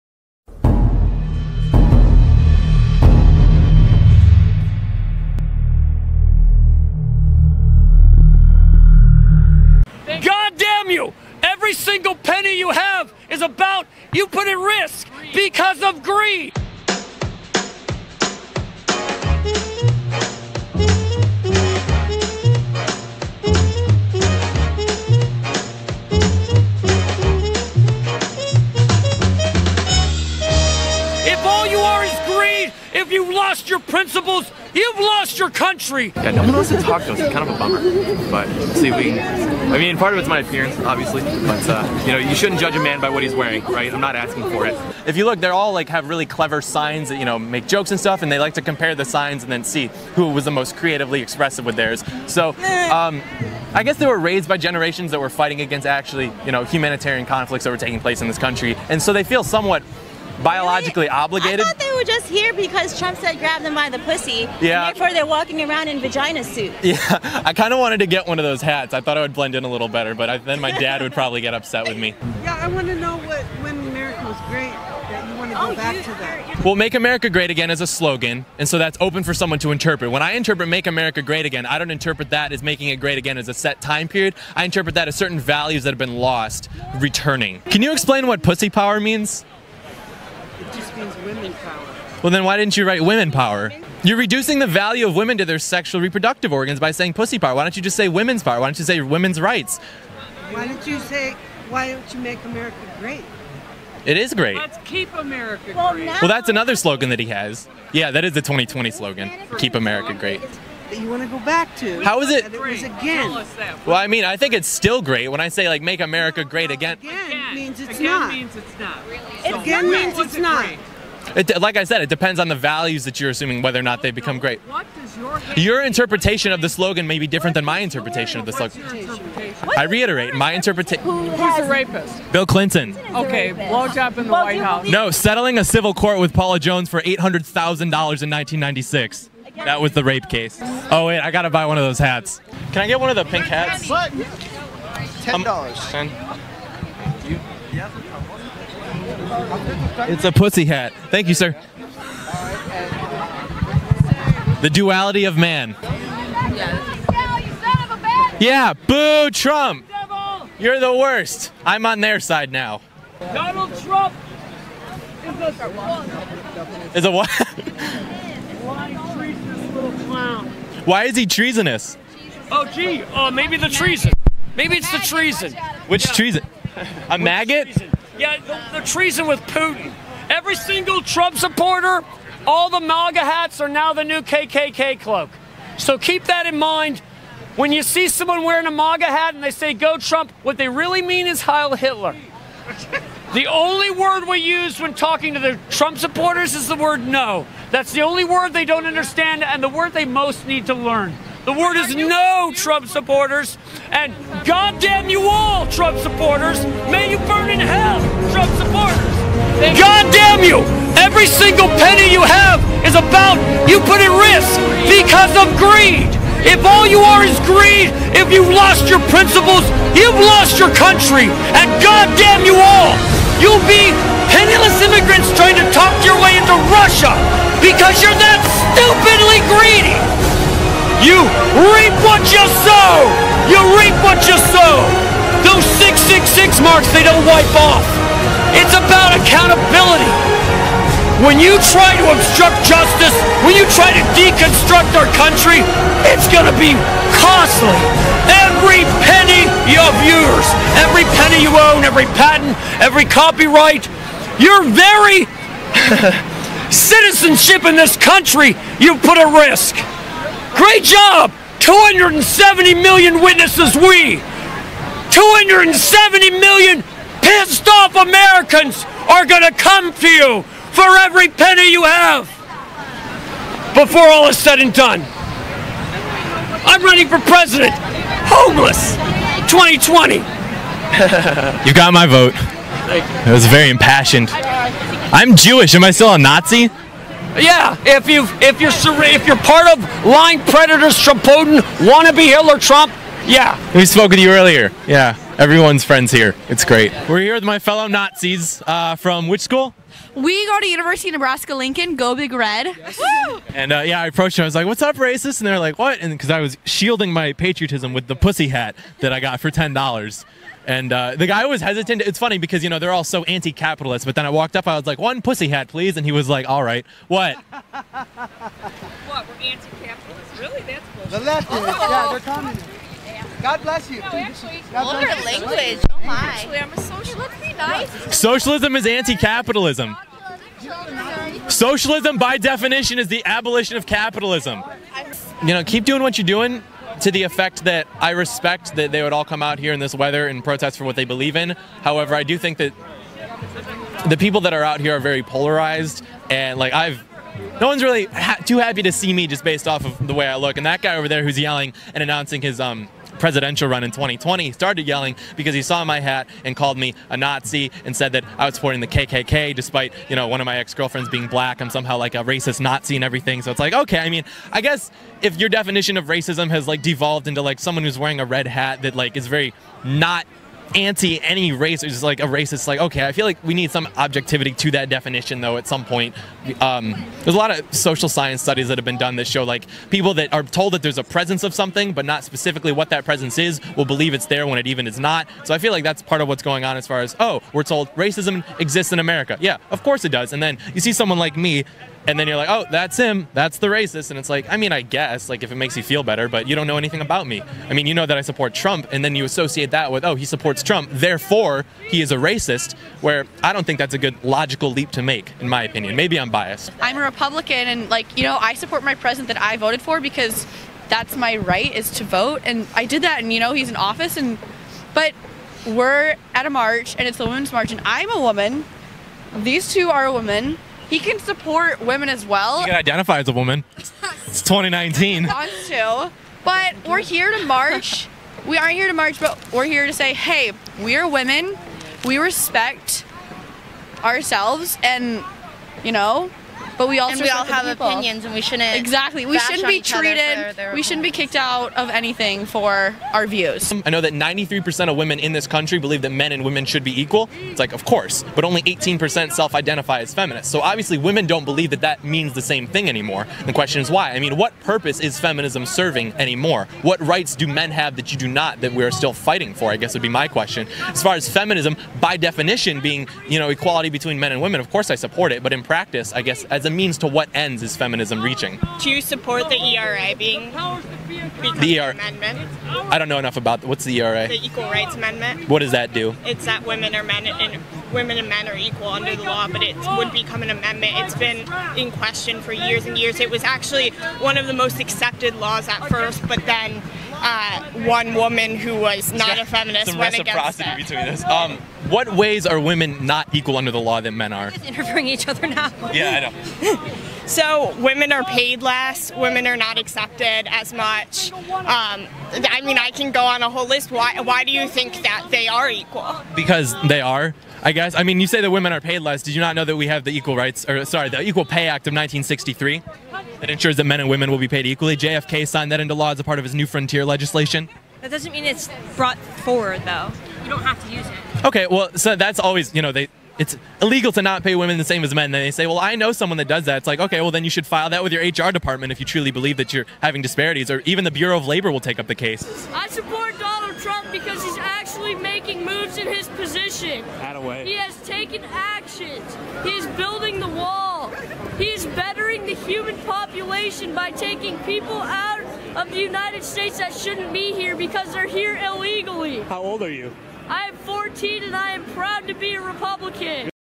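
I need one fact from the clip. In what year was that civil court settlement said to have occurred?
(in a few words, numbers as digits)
1996.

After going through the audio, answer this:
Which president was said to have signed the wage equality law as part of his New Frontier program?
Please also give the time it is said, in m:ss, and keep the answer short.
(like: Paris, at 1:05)
JFK, at 8:34.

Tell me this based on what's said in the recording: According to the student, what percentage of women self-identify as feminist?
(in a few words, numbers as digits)
18%.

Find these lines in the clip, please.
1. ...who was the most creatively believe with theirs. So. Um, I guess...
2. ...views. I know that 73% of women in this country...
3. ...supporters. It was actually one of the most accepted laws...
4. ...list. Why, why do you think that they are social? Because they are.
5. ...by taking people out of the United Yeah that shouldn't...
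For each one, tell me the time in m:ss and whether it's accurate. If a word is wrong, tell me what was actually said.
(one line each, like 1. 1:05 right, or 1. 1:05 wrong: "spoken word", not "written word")
1. 0:50 wrong: "expressive", not "believe"
2. 7:23 wrong: "93", not "73"
3. 8:02 wrong: "years", not "supporters"
4. 8:23 wrong: "equal", not "social"
5. 9:03 wrong: "States", not "Yeah".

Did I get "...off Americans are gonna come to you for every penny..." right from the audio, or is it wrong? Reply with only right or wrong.
right.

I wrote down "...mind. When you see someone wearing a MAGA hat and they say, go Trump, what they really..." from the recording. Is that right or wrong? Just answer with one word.
right.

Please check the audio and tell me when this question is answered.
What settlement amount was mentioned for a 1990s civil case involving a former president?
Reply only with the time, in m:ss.
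2:17.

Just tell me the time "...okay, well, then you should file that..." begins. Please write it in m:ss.
8:46.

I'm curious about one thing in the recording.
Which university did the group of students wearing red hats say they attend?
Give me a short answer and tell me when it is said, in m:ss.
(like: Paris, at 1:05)
University of Nebraska Lincoln, at 5:00.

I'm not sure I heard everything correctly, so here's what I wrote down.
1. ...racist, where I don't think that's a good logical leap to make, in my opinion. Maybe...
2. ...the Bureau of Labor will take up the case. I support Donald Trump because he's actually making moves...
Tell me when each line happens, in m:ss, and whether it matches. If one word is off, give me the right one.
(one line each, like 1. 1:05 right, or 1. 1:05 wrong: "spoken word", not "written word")
1. 6:42 right
2. 8:51 right.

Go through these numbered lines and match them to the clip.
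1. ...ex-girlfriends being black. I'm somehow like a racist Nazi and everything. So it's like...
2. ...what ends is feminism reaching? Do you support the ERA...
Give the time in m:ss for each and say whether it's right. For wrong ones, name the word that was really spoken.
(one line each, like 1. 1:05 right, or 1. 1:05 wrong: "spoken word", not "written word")
1. 6:00 right
2. 7:47 right.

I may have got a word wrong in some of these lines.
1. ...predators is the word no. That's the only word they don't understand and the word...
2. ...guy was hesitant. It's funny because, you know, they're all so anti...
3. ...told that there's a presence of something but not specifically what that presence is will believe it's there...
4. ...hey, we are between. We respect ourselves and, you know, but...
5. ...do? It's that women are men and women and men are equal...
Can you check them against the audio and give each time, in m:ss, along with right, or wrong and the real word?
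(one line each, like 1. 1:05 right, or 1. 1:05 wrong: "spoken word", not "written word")
1. 3:15 wrong: "supporters", not "predators"
2. 5:11 right
3. 6:20 right
4. 7:10 wrong: "women", not "between"
5. 7:55 right.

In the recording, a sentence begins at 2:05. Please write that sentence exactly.
Your, your interpretation of the slogan may be different than my interpretation of the slogan.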